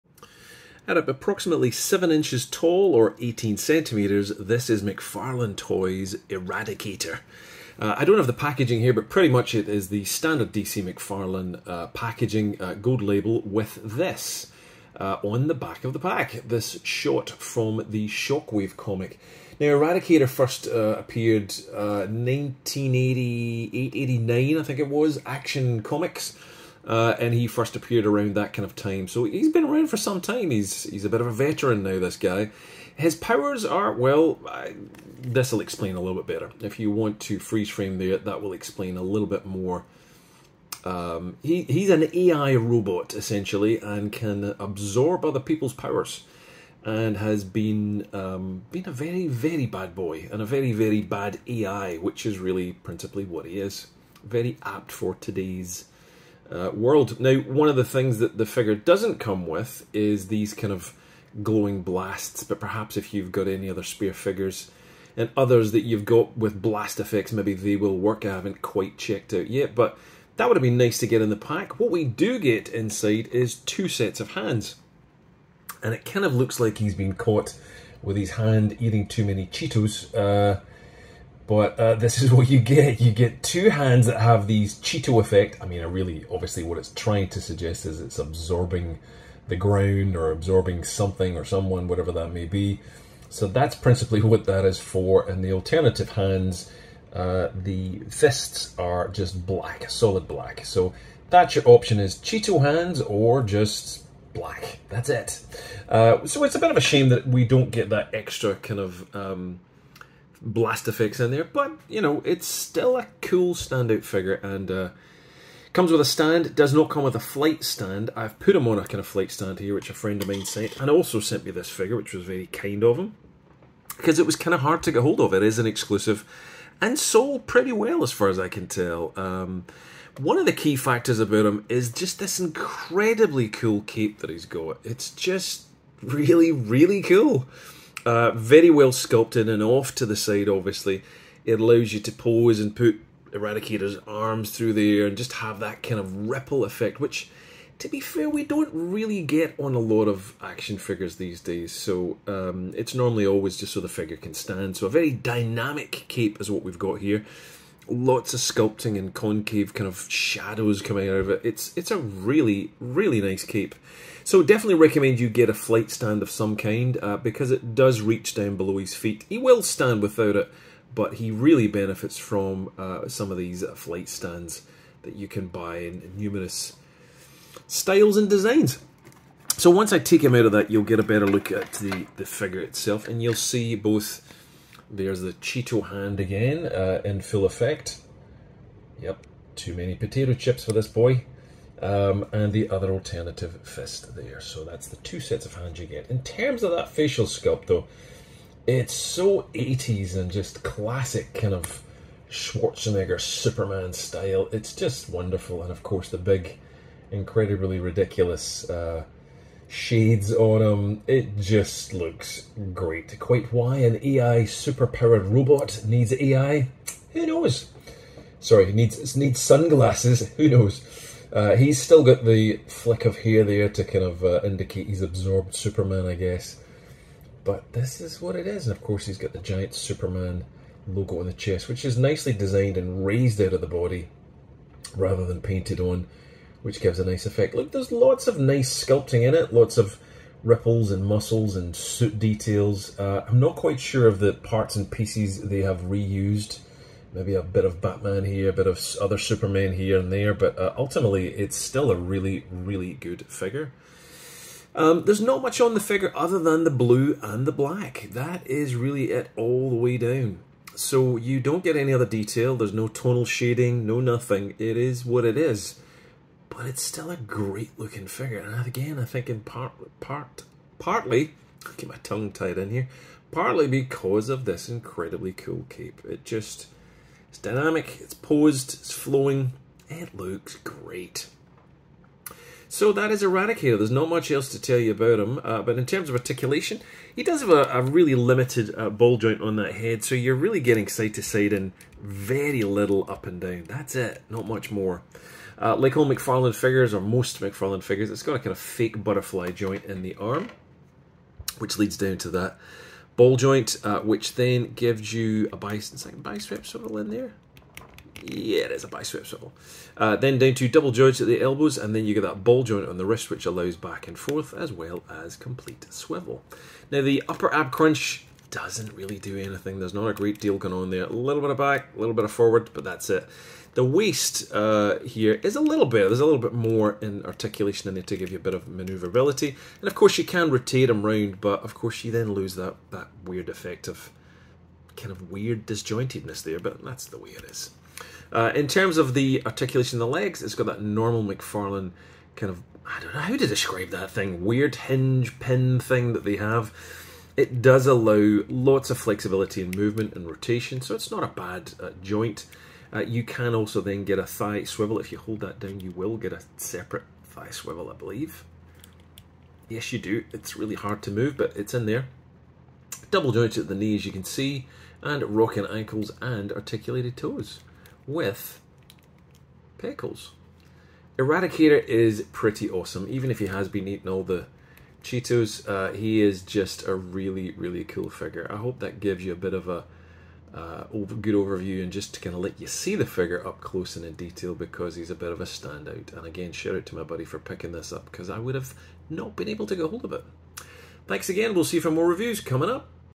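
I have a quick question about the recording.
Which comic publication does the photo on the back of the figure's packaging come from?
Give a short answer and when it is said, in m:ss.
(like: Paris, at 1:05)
Shockwave, at 0:18.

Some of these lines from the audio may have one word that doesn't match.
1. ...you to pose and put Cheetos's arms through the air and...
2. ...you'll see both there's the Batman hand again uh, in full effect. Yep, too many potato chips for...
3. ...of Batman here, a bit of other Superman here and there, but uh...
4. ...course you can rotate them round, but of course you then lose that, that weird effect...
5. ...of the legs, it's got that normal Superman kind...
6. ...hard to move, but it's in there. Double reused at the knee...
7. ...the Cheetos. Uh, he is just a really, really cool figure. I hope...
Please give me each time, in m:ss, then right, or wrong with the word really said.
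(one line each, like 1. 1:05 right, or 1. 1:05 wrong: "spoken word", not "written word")
1. 2:21 wrong: "Eradicator", not "Cheetos"
2. 3:03 wrong: "Cheeto", not "Batman"
3. 4:07 right
4. 5:29 right
5. 5:40 wrong: "McFarlane", not "Superman"
6. 6:00 wrong: "jointed", not "reused"
7. 6:14 right.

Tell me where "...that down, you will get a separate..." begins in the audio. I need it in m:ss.
5:55.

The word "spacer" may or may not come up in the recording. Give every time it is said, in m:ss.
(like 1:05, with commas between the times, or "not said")
not said.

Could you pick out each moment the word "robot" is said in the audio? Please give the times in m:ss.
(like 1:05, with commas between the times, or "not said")
0:42, 3:35.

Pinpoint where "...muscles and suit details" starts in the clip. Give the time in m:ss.
4:01.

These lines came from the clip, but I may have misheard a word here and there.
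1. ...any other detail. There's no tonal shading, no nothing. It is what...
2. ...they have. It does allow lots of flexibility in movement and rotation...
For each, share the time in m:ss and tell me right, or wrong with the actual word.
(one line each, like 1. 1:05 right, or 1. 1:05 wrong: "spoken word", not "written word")
1. 4:21 right
2. 5:46 right.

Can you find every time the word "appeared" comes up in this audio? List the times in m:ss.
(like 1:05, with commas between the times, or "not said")
0:20, 0:27.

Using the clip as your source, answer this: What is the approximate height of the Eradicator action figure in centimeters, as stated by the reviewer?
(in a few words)
18 centimeters.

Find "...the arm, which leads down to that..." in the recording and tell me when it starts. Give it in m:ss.
5:00.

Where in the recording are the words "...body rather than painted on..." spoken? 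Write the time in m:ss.
3:53.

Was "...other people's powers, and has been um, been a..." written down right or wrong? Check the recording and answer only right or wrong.
right.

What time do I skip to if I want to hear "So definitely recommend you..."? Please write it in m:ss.
2:44.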